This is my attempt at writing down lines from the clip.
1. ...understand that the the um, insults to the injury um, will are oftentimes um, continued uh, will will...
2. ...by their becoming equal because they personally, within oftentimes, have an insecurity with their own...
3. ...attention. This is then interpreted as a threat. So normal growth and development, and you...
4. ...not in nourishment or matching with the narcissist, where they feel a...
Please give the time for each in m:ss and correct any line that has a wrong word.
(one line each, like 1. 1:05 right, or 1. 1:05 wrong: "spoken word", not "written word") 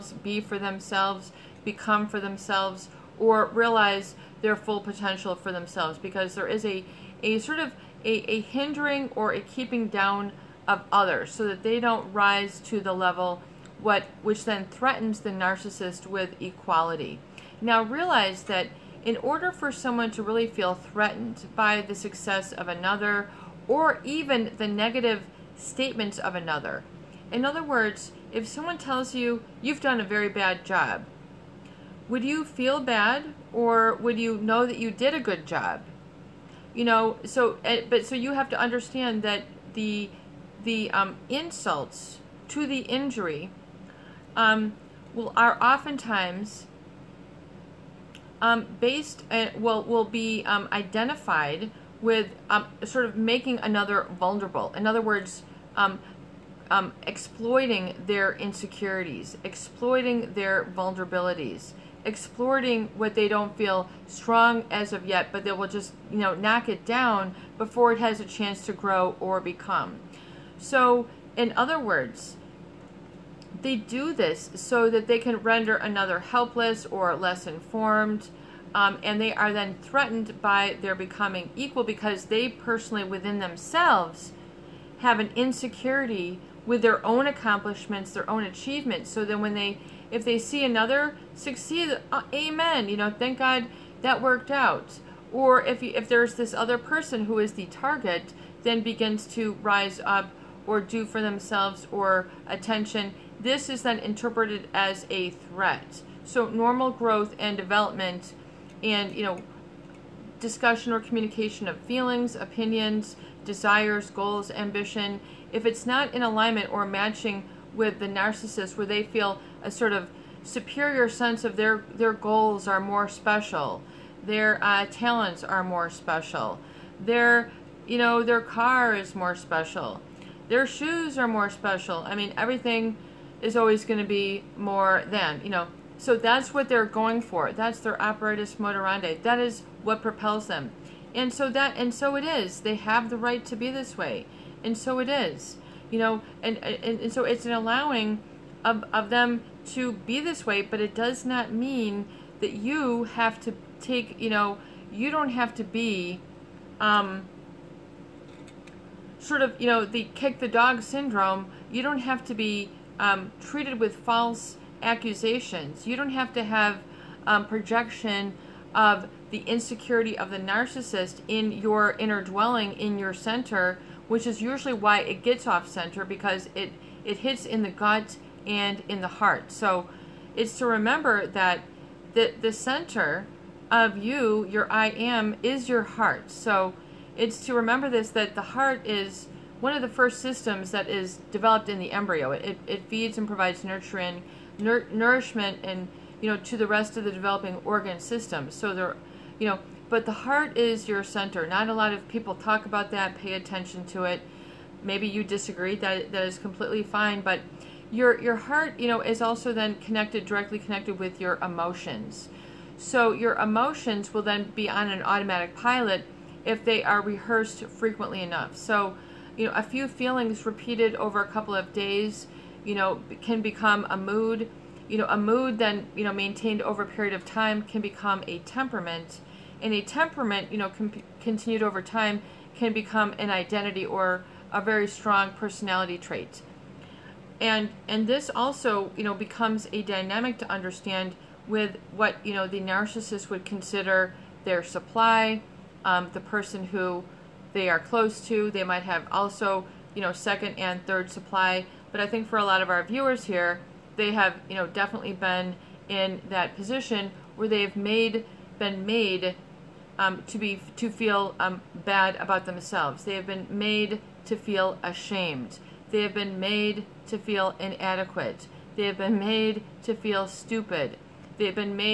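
1. 0:38 wrong: "based", not "continued"
2. 1:20 wrong: "themselves", not "oftentimes"
3. 1:42 right
4. 1:55 wrong: "alignment", not "nourishment".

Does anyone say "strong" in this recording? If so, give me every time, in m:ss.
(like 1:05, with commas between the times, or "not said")
1:04, 3:54.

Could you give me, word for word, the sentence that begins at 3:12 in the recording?
It, it feeds and provides nurturing, nur nourishment, and you know to the rest of the developing organ system.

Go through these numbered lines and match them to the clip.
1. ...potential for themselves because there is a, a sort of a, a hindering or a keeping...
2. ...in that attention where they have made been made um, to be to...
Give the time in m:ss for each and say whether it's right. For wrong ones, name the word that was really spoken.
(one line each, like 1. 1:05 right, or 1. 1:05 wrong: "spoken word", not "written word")
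1. 0:04 right
2. 4:15 wrong: "position", not "attention".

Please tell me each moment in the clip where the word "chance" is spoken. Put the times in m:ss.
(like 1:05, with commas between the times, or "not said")
1:08.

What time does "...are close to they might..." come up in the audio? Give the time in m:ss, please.
4:07.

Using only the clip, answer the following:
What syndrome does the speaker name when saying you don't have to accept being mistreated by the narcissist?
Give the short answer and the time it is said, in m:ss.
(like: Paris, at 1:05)
Kick the dog syndrome, at 2:40.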